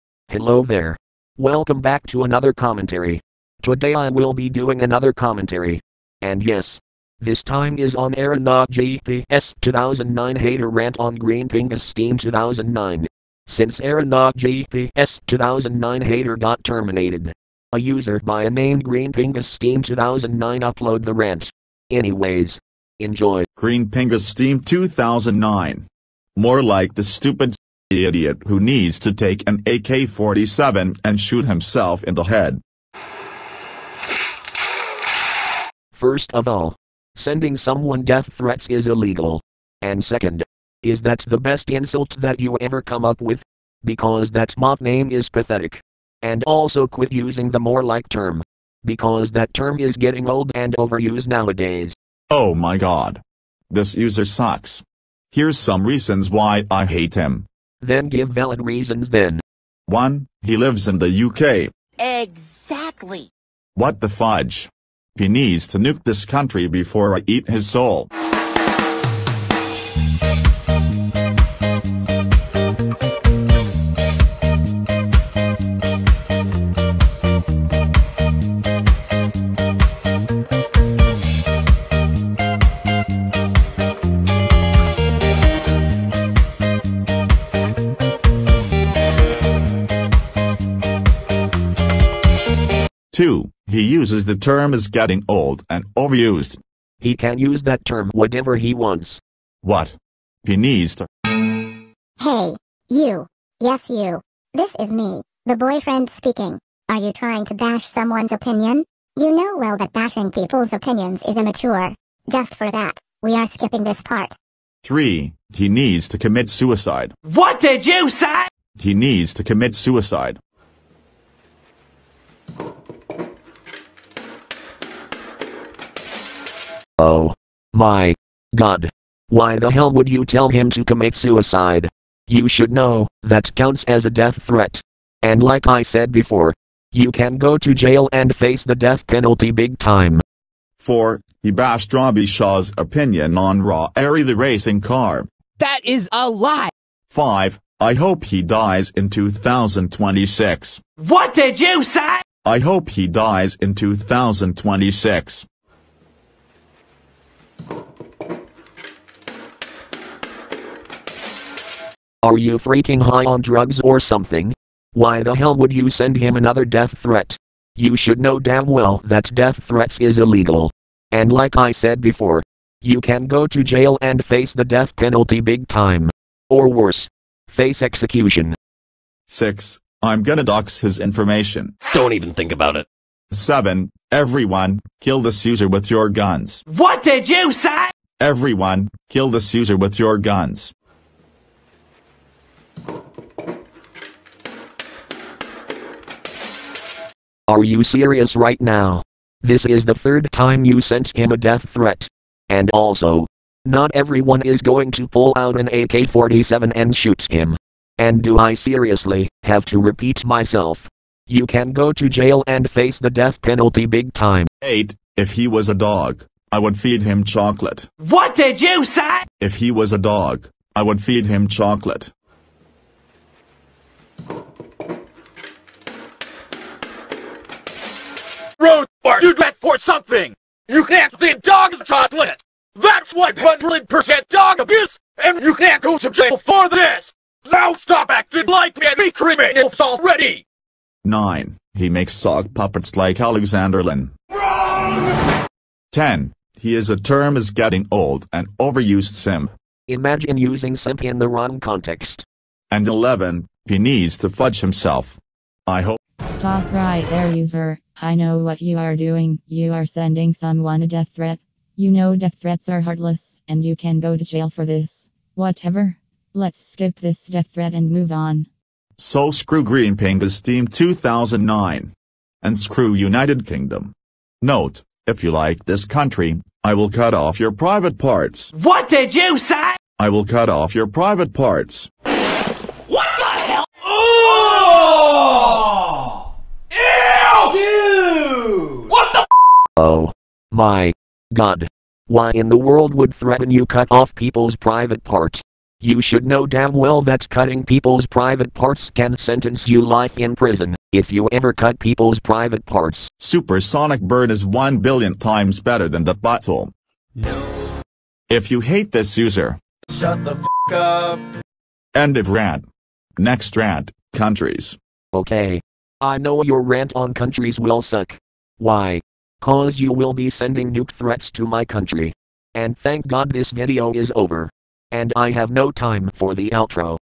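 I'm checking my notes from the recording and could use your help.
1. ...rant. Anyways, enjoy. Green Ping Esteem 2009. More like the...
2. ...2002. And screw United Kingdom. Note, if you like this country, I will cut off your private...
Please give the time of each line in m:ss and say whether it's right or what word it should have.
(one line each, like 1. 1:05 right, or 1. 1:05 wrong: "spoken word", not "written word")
1. 0:21 right
2. 4:30 wrong: "2009", not "2002".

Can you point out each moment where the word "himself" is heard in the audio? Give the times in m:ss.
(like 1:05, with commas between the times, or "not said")
0:31, 4:14.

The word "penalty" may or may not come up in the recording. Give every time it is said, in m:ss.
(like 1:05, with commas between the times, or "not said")
2:19, 2:54, 3:33.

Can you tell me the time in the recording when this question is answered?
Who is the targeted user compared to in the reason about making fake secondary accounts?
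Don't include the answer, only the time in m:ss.
4:03.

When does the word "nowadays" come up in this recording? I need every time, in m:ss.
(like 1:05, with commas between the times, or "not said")
0:51.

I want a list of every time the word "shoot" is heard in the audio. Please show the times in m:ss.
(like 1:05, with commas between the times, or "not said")
0:31, 3:26.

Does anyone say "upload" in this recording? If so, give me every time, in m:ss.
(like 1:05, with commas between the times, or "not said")
0:20.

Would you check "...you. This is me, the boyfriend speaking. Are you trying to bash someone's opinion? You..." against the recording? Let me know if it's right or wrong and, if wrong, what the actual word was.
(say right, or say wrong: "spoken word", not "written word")
right.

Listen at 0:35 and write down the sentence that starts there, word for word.
First of all, sending someone death threats is illegal.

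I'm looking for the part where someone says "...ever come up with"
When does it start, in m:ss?
0:42.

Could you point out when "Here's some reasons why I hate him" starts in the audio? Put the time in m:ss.
0:55.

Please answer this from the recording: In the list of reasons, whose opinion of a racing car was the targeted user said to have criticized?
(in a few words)
Robbie Shaw.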